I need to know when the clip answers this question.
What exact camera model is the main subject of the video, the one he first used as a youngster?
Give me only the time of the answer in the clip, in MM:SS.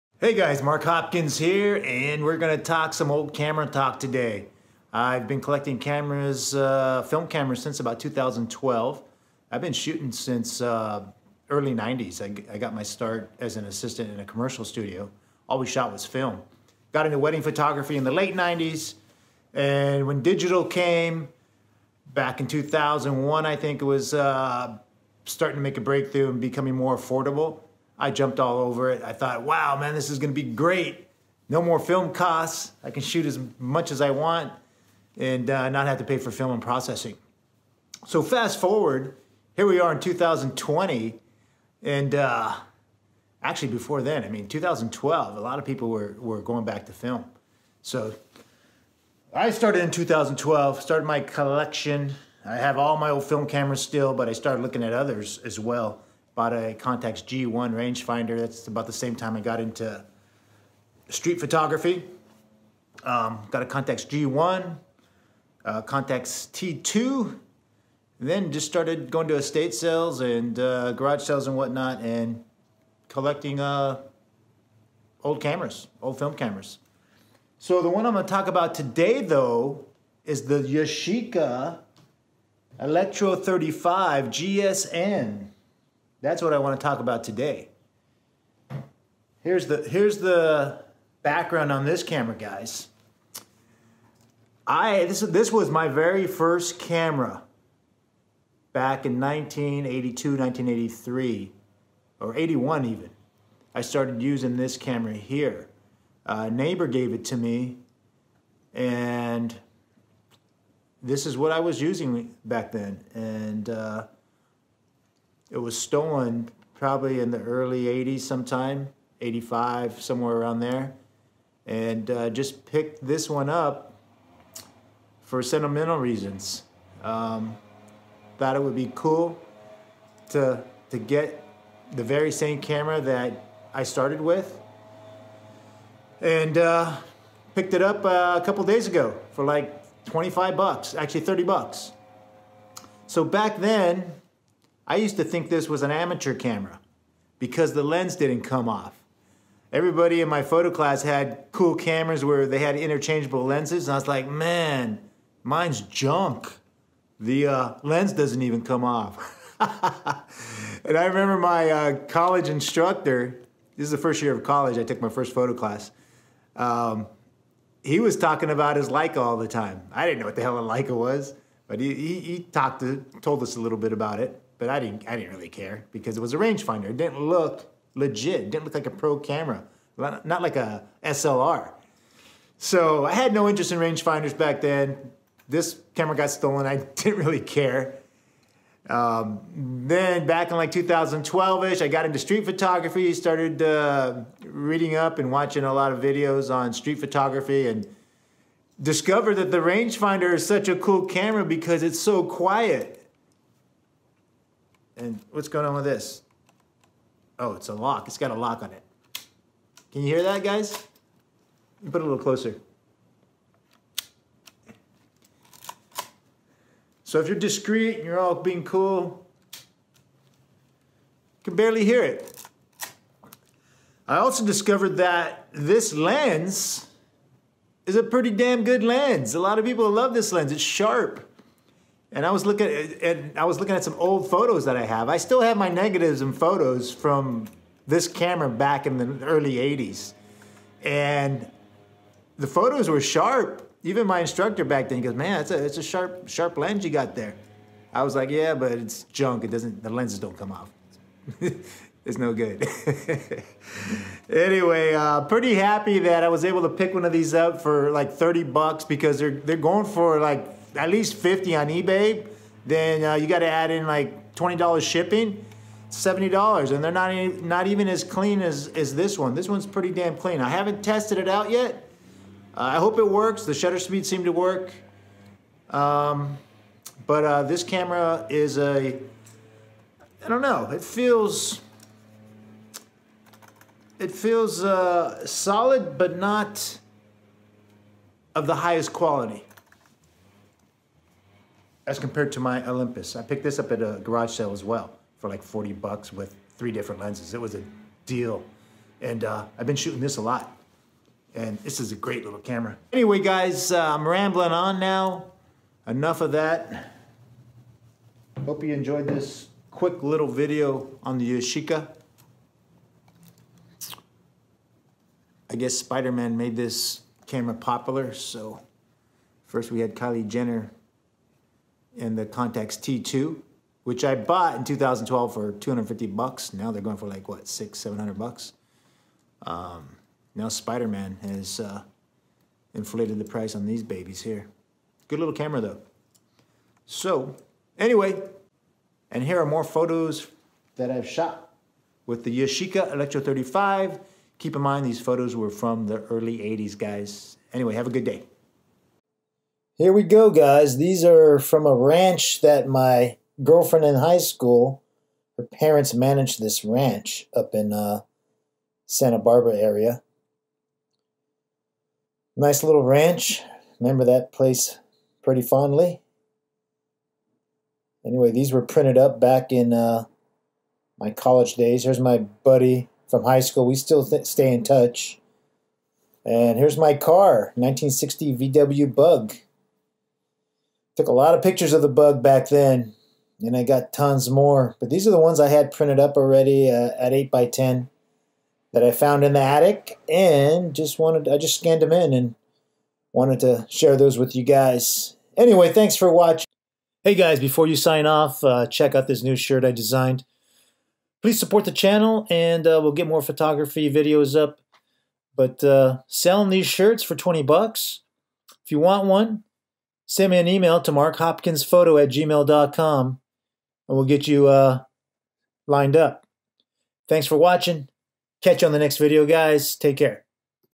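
01:20.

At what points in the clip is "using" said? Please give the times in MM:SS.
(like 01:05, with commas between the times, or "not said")
01:44, 01:51.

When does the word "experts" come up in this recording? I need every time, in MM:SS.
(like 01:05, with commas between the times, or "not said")
not said.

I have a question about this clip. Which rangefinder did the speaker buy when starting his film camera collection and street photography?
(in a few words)
Contax G1.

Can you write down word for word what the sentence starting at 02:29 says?
Everybody in my photo class had cool cameras where they had interchangeable lenses, and I was like, man, mine's junk.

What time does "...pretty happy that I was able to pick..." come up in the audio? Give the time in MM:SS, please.
04:15.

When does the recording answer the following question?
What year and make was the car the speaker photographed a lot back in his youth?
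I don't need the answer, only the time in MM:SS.
06:17.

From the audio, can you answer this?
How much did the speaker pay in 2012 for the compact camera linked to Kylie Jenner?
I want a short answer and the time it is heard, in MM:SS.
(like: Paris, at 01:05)
$250, at 05:25.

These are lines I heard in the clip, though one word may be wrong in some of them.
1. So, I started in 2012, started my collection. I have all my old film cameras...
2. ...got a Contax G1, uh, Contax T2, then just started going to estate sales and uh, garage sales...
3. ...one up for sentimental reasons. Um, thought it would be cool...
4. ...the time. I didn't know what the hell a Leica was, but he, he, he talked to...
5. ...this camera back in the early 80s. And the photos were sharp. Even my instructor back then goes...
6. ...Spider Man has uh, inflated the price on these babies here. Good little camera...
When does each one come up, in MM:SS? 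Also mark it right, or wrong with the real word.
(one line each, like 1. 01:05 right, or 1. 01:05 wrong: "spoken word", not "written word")
1. 00:47 right
2. 01:03 right
3. 02:03 right
4. 02:49 right
5. 03:57 right
6. 05:30 right.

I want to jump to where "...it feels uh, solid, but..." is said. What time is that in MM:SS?
04:43.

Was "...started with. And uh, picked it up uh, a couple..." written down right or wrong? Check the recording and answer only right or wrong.
right.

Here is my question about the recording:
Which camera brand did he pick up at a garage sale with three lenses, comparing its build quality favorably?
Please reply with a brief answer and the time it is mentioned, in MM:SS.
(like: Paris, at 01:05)
Olympus, at 04:52.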